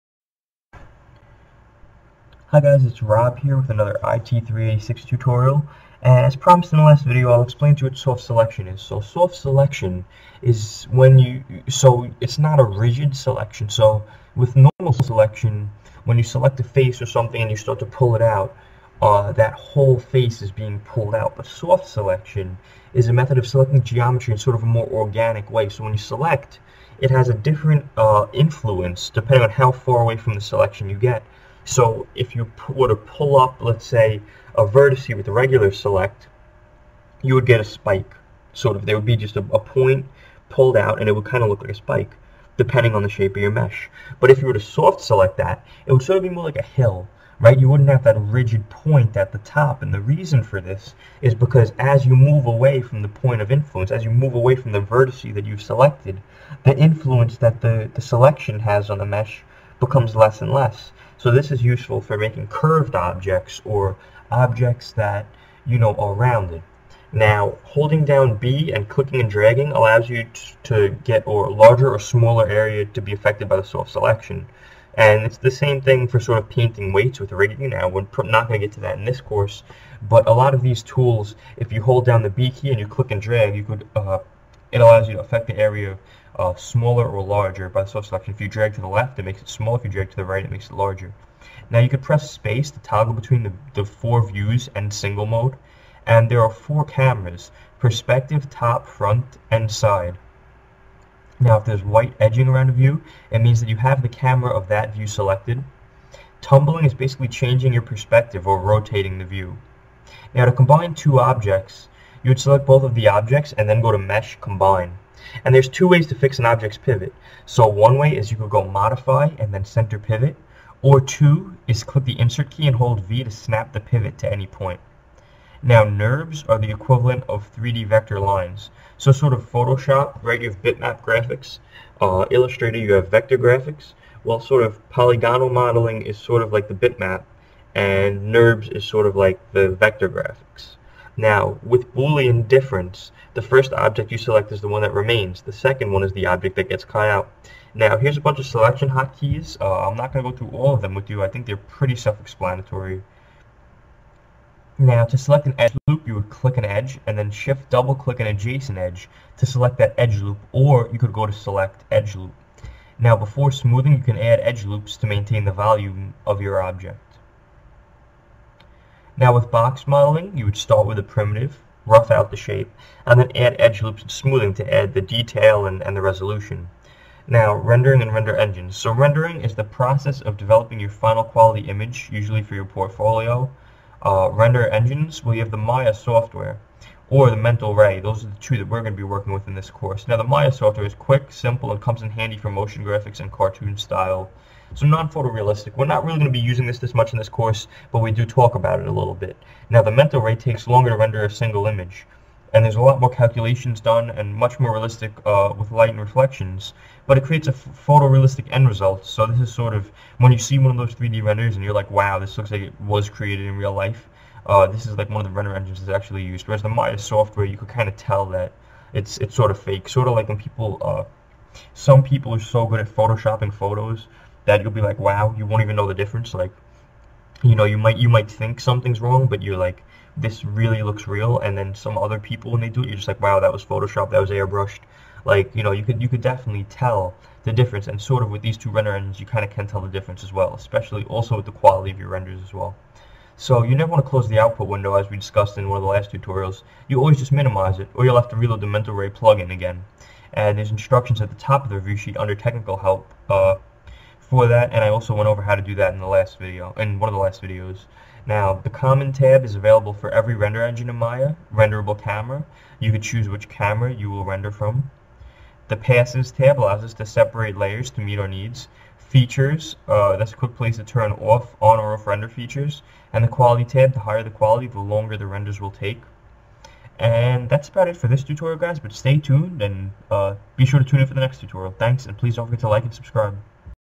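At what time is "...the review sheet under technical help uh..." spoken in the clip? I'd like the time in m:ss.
4:11.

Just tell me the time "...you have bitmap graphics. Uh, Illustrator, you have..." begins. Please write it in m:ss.
2:10.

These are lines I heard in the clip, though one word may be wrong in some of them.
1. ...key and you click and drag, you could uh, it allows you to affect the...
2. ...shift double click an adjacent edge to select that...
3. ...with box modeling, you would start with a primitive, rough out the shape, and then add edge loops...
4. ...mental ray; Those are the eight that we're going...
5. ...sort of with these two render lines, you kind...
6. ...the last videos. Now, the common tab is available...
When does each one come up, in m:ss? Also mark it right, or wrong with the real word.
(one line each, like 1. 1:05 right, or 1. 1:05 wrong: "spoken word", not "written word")
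1. 1:22 right
2. 2:37 right
3. 2:49 right
4. 3:07 wrong: "two", not "eight"
5. 3:58 wrong: "engines", not "lines"
6. 4:17 right.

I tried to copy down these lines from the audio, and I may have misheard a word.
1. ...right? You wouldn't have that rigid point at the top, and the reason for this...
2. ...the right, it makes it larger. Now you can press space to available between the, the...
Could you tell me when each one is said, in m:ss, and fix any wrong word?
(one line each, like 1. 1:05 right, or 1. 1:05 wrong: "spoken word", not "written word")
1. 0:47 right
2. 1:30 wrong: "toggle", not "available".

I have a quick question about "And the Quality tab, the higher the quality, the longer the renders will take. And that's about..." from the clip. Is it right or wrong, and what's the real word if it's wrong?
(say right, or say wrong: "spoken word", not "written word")
right.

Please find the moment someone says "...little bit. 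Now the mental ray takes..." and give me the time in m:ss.
3:18.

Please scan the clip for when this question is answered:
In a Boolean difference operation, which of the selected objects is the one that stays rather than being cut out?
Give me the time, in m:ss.
2:23.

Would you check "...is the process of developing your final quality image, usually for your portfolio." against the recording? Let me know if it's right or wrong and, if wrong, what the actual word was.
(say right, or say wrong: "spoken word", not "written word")
right.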